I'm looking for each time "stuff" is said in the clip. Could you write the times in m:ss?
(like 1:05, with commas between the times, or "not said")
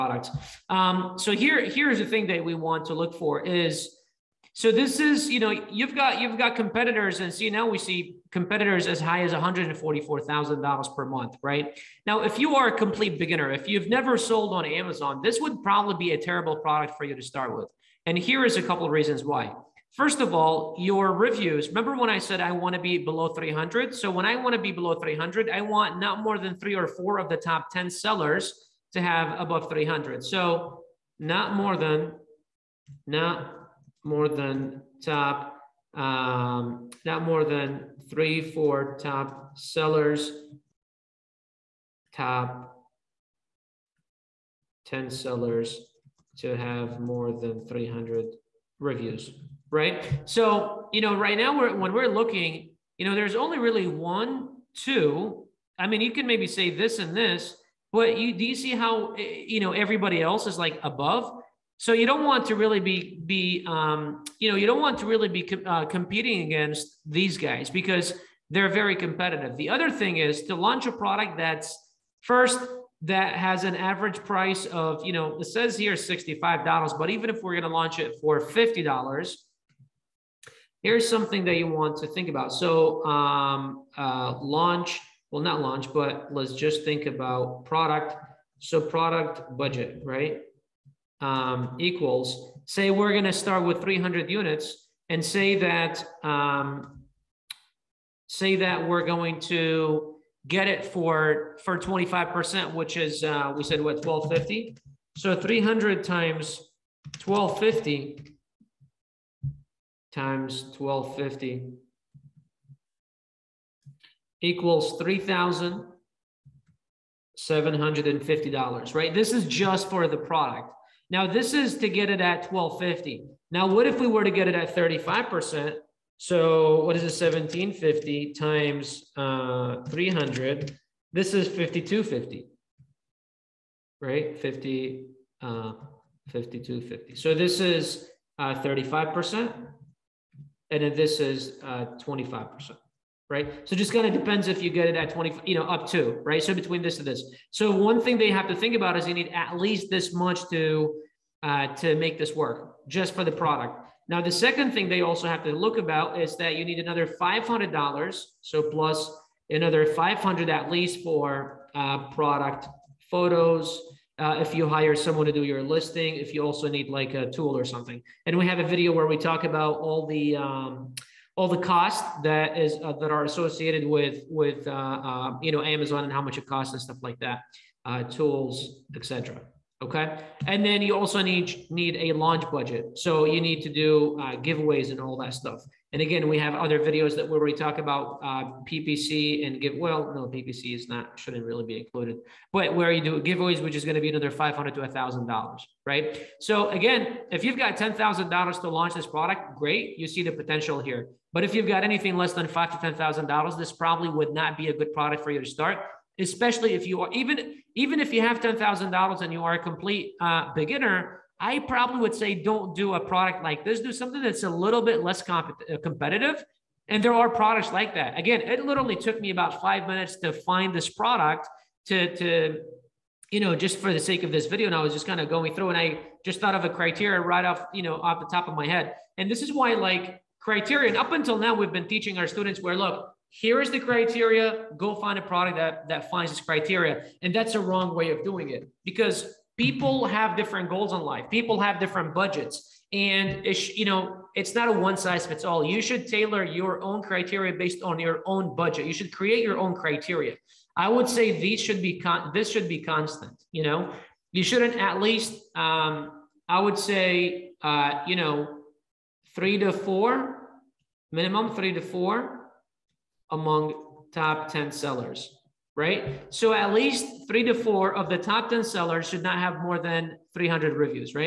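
2:56, 3:05.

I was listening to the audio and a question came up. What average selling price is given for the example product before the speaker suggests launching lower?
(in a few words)
$65.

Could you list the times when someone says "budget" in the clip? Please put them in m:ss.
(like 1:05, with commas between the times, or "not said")
1:29, 3:02, 4:02, 4:08.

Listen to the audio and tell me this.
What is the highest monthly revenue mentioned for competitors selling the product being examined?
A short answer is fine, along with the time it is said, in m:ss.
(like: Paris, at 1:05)
$144,000, at 0:09.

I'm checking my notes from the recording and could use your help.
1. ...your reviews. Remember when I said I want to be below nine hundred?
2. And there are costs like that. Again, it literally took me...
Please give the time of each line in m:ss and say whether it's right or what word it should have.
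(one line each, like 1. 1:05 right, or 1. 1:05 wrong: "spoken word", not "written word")
1. 0:20 wrong: "three", not "nine"
2. 3:36 wrong: "products", not "costs".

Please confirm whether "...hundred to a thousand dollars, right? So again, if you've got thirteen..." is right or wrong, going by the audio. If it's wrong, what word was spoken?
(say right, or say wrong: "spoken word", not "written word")
wrong: "ten", not "thirteen".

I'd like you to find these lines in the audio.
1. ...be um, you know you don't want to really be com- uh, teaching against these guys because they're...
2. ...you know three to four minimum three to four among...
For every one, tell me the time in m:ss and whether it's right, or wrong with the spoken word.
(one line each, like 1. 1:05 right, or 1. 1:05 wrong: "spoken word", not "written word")
1. 1:03 wrong: "competing", not "teaching"
2. 4:18 right.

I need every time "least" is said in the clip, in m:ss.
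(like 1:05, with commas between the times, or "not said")
2:29, 2:40, 4:14, 4:26.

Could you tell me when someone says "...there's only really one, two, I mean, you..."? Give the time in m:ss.
0:53.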